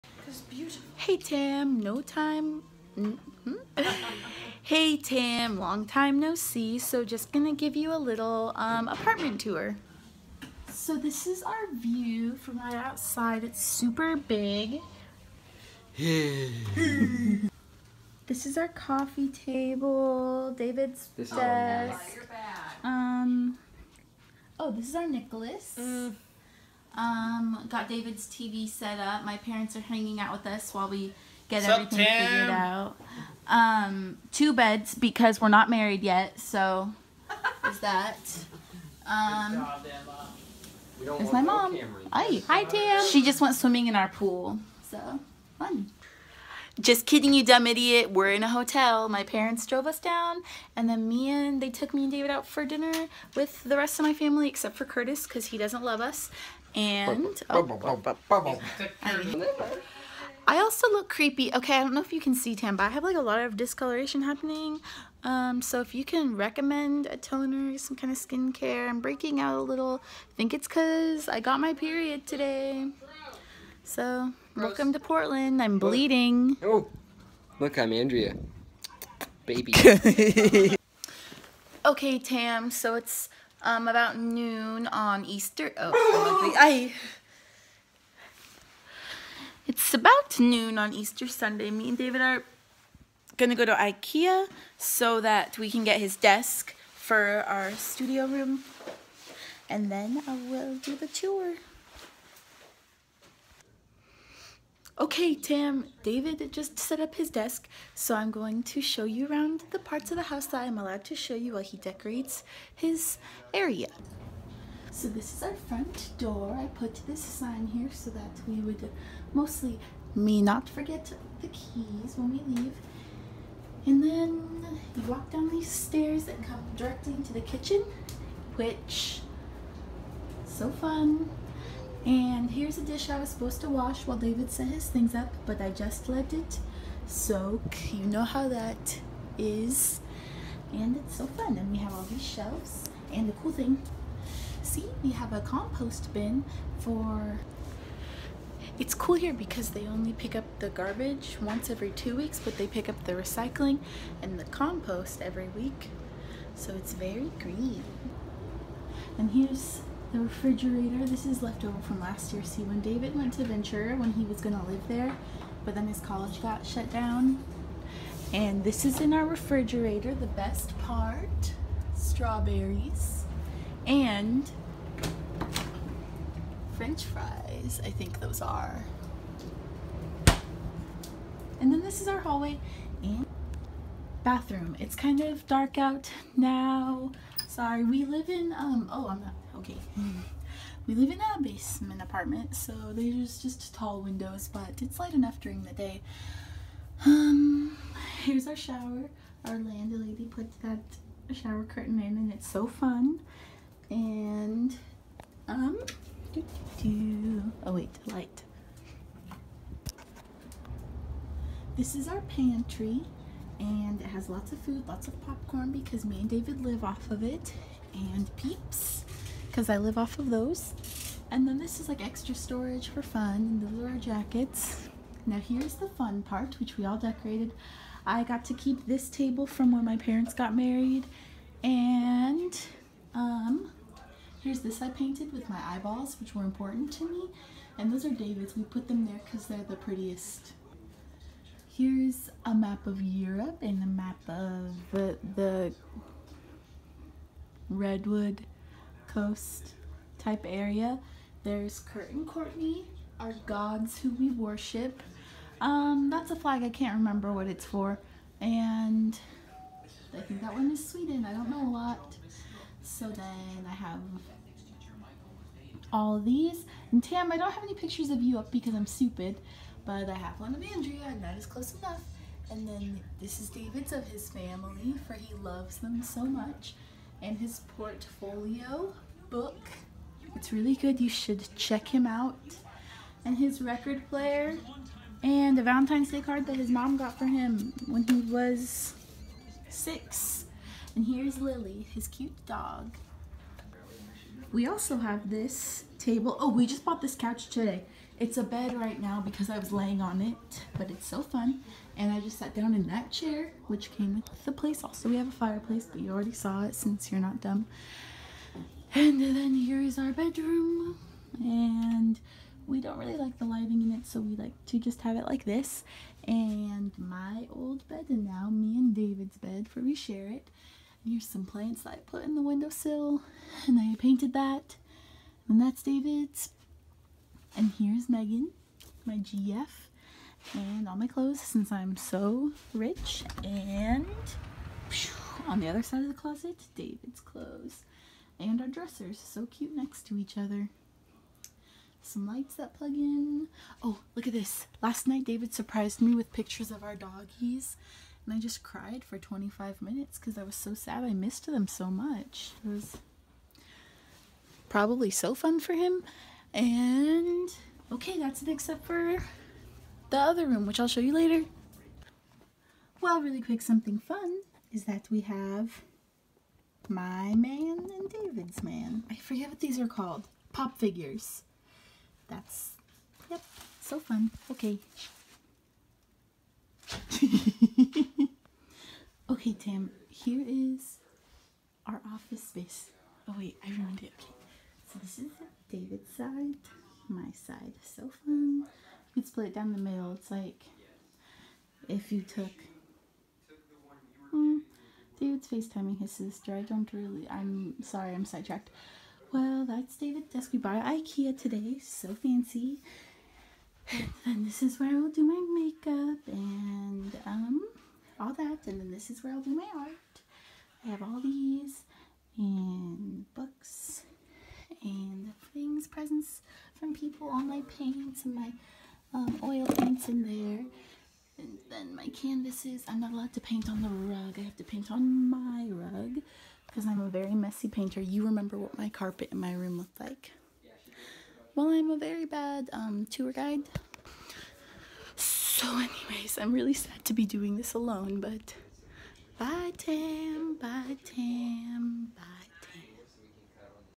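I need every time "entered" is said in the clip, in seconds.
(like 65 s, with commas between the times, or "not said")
not said.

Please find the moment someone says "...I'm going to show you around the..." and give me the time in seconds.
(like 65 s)
108 s.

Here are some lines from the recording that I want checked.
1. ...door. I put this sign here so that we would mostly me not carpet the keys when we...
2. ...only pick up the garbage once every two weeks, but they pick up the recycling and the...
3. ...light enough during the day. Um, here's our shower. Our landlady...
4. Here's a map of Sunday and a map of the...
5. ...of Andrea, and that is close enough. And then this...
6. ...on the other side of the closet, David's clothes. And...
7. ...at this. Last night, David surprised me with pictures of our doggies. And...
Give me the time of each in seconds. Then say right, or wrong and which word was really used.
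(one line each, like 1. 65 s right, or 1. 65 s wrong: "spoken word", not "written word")
1. 116 s wrong: "forget", not "carpet"
2. 149 s right
3. 194 s right
4. 241 s wrong: "Europe", not "Sunday"
5. 270 s right
6. 335 s right
7. 344 s right.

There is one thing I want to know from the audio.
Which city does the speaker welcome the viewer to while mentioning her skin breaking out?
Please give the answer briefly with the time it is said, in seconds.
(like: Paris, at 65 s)
Portland, at 74 s.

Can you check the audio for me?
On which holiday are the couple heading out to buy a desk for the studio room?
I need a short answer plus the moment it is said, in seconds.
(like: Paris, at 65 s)
Easter Sunday, at 90 s.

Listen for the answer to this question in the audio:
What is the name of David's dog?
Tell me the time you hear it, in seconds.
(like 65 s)
291 s.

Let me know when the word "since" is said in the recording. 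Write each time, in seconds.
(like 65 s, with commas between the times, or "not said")
306 s, 331 s.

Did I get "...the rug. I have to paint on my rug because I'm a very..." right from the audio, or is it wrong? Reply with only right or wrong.
right.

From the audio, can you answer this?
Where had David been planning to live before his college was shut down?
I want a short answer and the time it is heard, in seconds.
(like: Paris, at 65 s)
Ventura, at 163 s.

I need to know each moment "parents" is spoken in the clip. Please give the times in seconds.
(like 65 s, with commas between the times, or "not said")
29 s, 49 s, 229 s.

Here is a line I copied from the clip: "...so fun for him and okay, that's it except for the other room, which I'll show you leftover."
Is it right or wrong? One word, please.
wrong.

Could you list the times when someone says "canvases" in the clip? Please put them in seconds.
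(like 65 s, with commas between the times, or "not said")
422 s.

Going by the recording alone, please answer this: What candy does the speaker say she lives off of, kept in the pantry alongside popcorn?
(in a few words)
Peeps.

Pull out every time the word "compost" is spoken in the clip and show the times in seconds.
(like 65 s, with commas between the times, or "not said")
145 s, 154 s.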